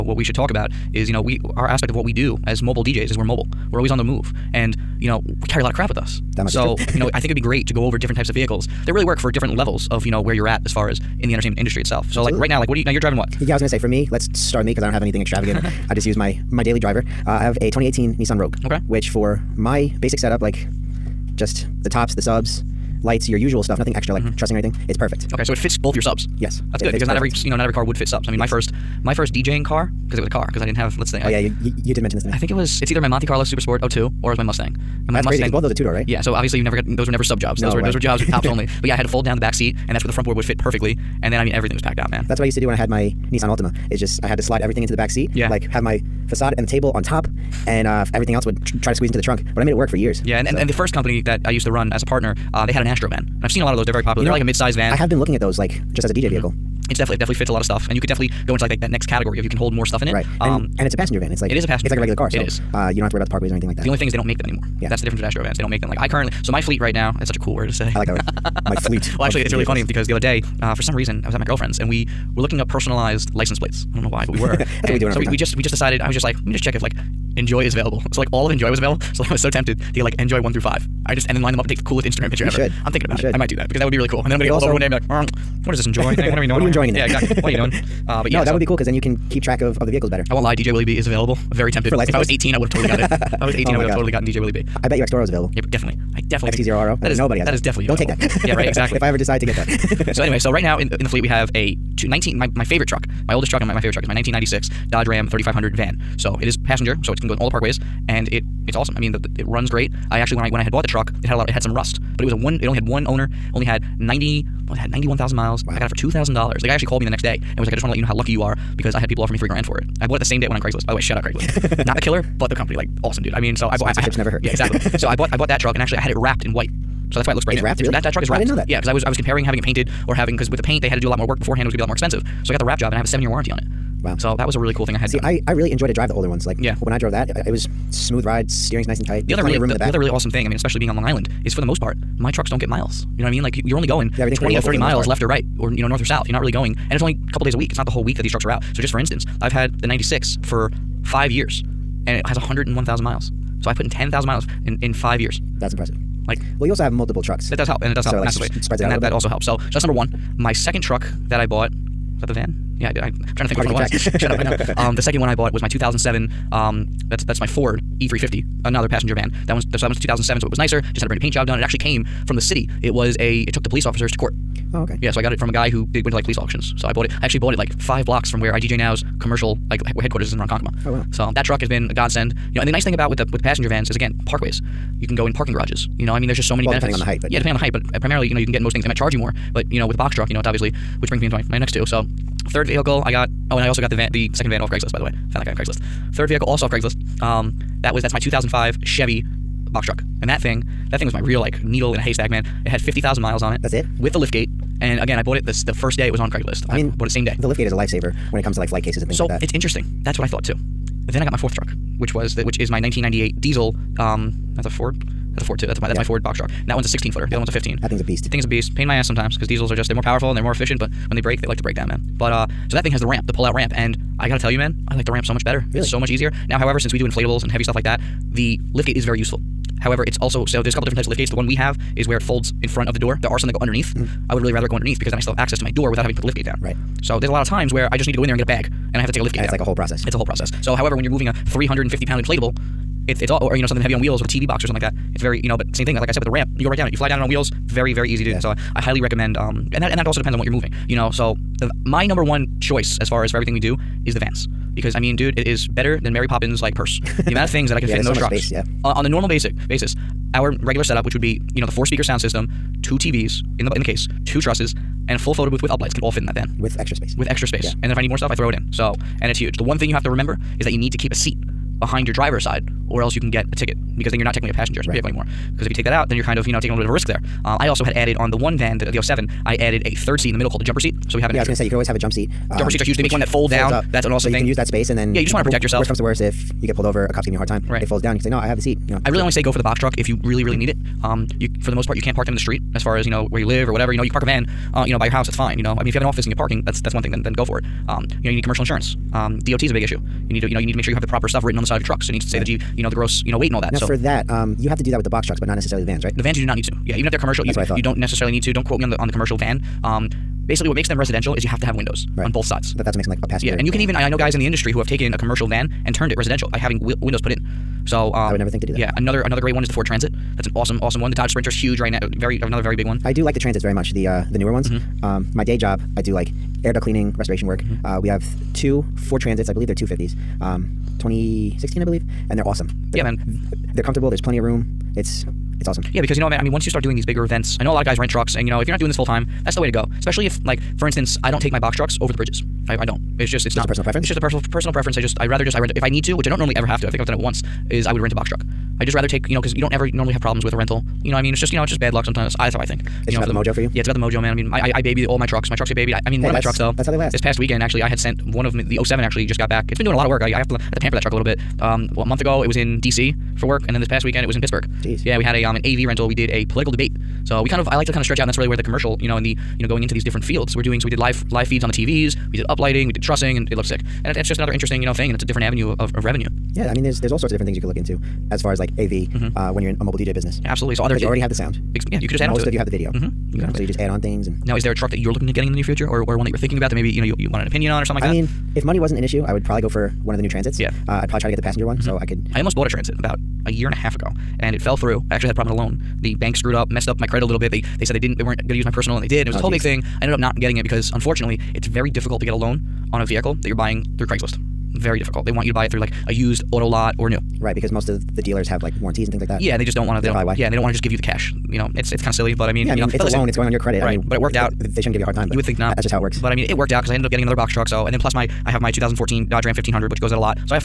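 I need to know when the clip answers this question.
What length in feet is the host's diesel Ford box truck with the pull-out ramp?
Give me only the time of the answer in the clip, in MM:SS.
03:36.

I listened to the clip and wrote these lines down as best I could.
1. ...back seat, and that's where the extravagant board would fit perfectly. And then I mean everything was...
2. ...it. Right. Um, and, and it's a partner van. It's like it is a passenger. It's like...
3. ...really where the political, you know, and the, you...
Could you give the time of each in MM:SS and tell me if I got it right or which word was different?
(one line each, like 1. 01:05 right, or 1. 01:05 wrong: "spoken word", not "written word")
1. 00:39 wrong: "front", not "extravagant"
2. 01:00 wrong: "passenger", not "partner"
3. 06:08 wrong: "commercial", not "political".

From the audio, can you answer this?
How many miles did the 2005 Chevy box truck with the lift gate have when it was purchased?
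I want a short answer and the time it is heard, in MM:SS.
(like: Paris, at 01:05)
50,000, at 03:22.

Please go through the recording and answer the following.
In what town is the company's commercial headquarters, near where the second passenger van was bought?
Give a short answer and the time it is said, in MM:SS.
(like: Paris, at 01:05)
Ronkonkoma, at 03:00.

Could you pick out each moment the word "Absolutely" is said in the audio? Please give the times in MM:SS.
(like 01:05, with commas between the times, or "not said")
00:12, 06:20.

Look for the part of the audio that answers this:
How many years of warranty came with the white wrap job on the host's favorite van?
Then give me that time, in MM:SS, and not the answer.
02:13.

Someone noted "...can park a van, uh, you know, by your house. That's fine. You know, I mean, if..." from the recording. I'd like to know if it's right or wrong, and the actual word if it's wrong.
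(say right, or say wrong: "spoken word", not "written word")
right.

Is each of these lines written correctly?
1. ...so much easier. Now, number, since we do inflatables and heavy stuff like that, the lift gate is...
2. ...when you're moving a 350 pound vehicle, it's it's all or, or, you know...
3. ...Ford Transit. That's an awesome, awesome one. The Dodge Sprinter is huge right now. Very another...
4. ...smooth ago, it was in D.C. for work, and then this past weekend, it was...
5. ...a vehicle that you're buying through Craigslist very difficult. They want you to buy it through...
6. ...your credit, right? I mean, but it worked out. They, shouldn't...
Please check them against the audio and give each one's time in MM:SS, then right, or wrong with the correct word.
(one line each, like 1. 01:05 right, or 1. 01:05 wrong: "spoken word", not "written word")
1. 03:45 wrong: "however", not "number"
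2. 04:00 wrong: "inflatable", not "vehicle"
3. 05:19 right
4. 06:02 wrong: "month", not "smooth"
5. 06:42 right
6. 06:53 right.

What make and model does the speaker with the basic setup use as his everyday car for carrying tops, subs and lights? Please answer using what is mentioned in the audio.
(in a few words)
2018 Nissan Rogue.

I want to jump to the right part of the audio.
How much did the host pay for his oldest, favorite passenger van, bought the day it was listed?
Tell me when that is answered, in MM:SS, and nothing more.
01:55.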